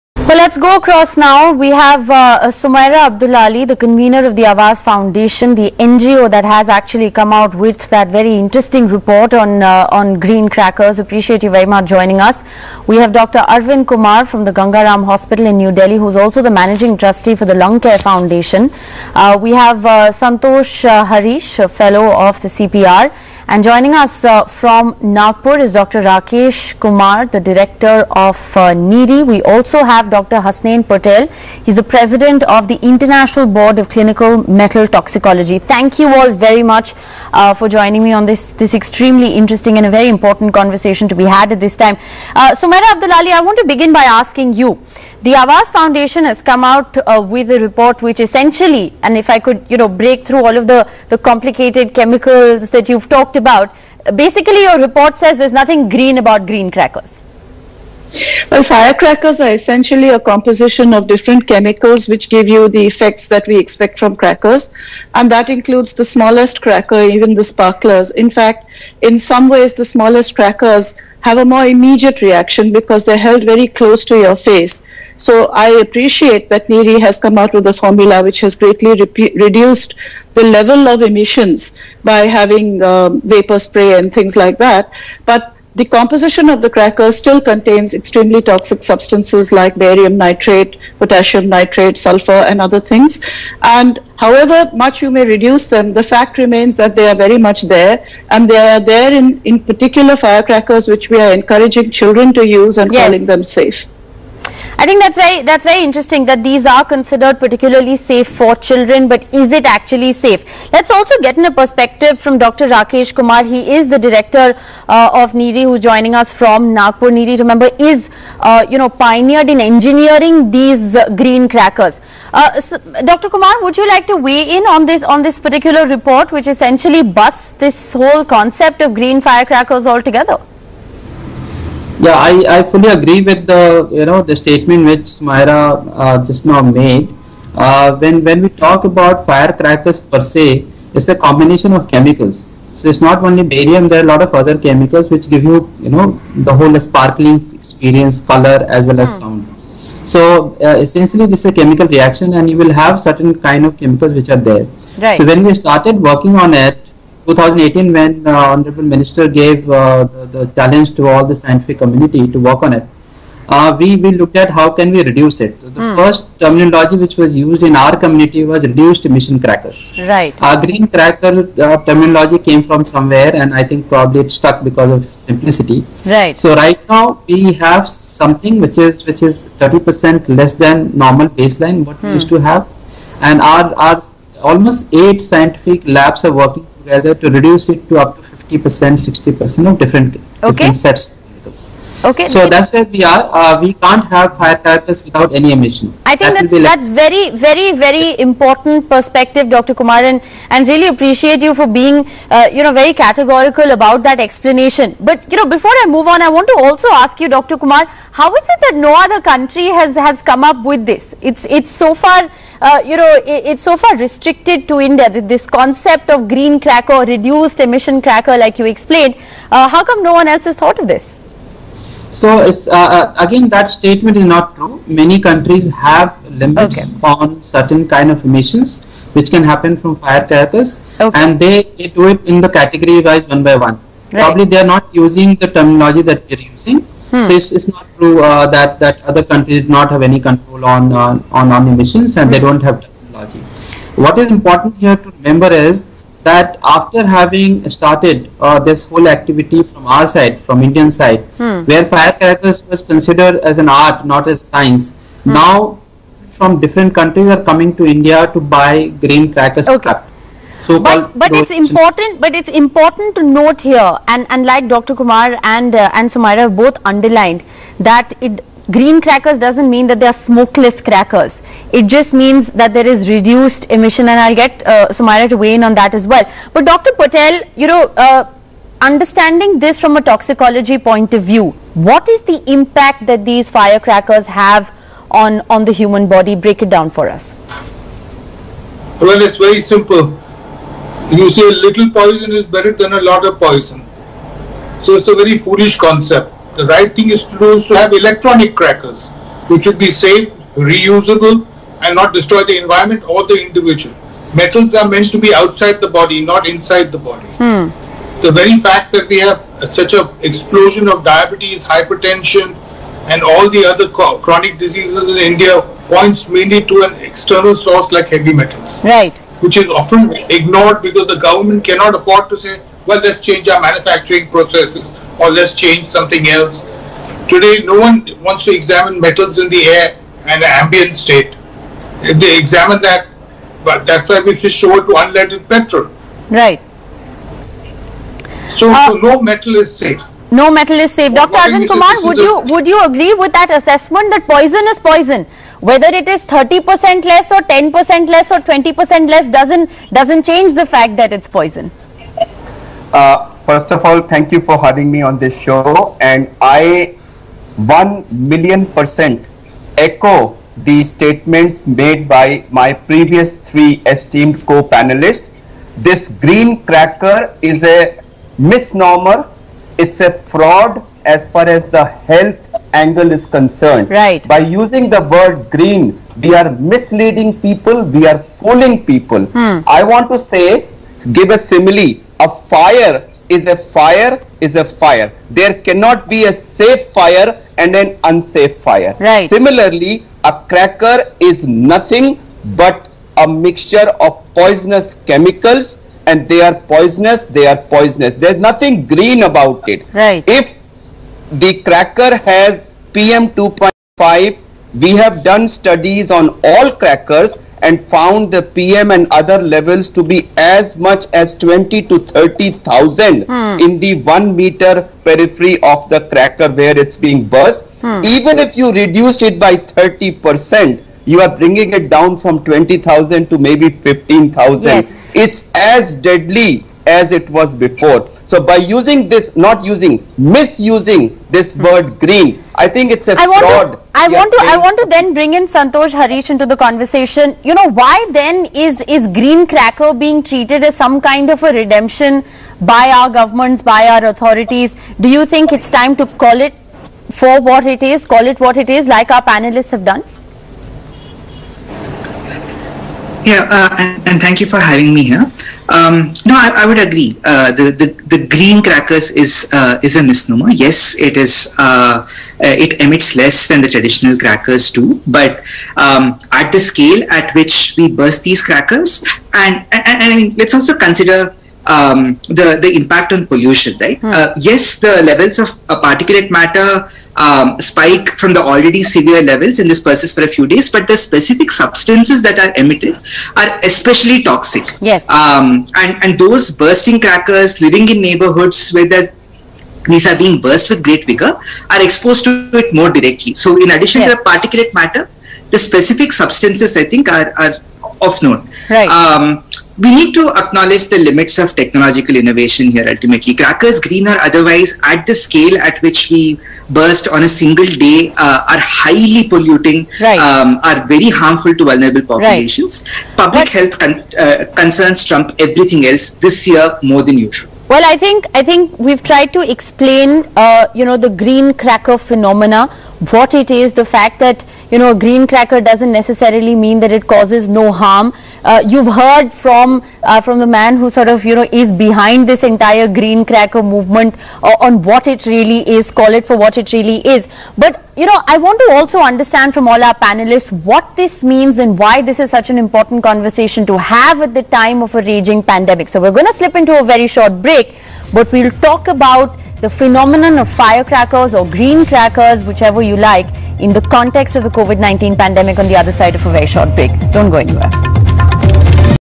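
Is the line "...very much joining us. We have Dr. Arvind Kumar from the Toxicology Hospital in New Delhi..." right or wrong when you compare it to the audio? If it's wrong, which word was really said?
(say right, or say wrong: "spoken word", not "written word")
wrong: "Gangaram", not "Toxicology".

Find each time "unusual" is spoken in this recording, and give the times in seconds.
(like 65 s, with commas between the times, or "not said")
not said.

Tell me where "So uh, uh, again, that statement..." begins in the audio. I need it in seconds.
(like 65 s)
222 s.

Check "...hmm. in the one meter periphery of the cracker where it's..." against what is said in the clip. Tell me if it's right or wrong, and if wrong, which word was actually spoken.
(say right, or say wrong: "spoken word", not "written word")
right.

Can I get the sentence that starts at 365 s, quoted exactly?
This green cracker is a misnomer, it's a fraud as far as the health angle is concerned.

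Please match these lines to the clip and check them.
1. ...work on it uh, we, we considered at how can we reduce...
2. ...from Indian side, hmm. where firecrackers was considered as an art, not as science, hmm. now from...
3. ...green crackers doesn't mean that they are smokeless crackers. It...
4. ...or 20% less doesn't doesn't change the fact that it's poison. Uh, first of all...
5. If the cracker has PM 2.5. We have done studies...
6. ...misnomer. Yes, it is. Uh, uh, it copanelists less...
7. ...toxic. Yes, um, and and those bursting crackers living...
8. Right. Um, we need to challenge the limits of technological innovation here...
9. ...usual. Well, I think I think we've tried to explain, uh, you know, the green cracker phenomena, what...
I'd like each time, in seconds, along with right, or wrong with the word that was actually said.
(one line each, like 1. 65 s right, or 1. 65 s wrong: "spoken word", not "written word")
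1. 162 s wrong: "looked", not "considered"
2. 250 s right
3. 268 s right
4. 348 s right
5. 400 s right
6. 460 s wrong: "emits", not "copanelists"
7. 484 s right
8. 498 s wrong: "acknowledge", not "challenge"
9. 517 s right.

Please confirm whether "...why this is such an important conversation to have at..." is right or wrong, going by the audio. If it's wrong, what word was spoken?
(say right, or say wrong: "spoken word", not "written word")
right.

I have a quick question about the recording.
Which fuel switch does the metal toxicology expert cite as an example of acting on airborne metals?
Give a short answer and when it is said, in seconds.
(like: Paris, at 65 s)
unleaded petrol, at 335 s.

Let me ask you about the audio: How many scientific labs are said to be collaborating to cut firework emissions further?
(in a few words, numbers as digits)
8.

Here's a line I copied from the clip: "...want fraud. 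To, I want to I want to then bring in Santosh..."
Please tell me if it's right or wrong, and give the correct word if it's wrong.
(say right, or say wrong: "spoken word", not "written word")
right.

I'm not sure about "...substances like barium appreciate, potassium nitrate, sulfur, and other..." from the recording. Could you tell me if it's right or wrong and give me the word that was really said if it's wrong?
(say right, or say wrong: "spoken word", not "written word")
wrong: "nitrate", not "appreciate".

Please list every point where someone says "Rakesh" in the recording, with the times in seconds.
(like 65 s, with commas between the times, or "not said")
26 s, 112 s.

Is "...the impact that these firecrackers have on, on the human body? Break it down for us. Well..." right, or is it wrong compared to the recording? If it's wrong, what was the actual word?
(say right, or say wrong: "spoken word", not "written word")
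right.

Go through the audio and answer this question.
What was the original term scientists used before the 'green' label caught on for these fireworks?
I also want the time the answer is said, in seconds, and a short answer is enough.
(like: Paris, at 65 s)
reduced emission crackers, at 168 s.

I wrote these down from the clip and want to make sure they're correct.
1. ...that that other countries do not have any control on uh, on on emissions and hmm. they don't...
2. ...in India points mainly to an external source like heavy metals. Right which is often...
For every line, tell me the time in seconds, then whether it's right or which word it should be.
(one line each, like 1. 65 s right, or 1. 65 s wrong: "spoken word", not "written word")
1. 238 s right
2. 315 s right.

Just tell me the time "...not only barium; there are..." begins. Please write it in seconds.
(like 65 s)
143 s.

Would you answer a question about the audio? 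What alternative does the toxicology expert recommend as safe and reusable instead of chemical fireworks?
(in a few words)
electronic crackers.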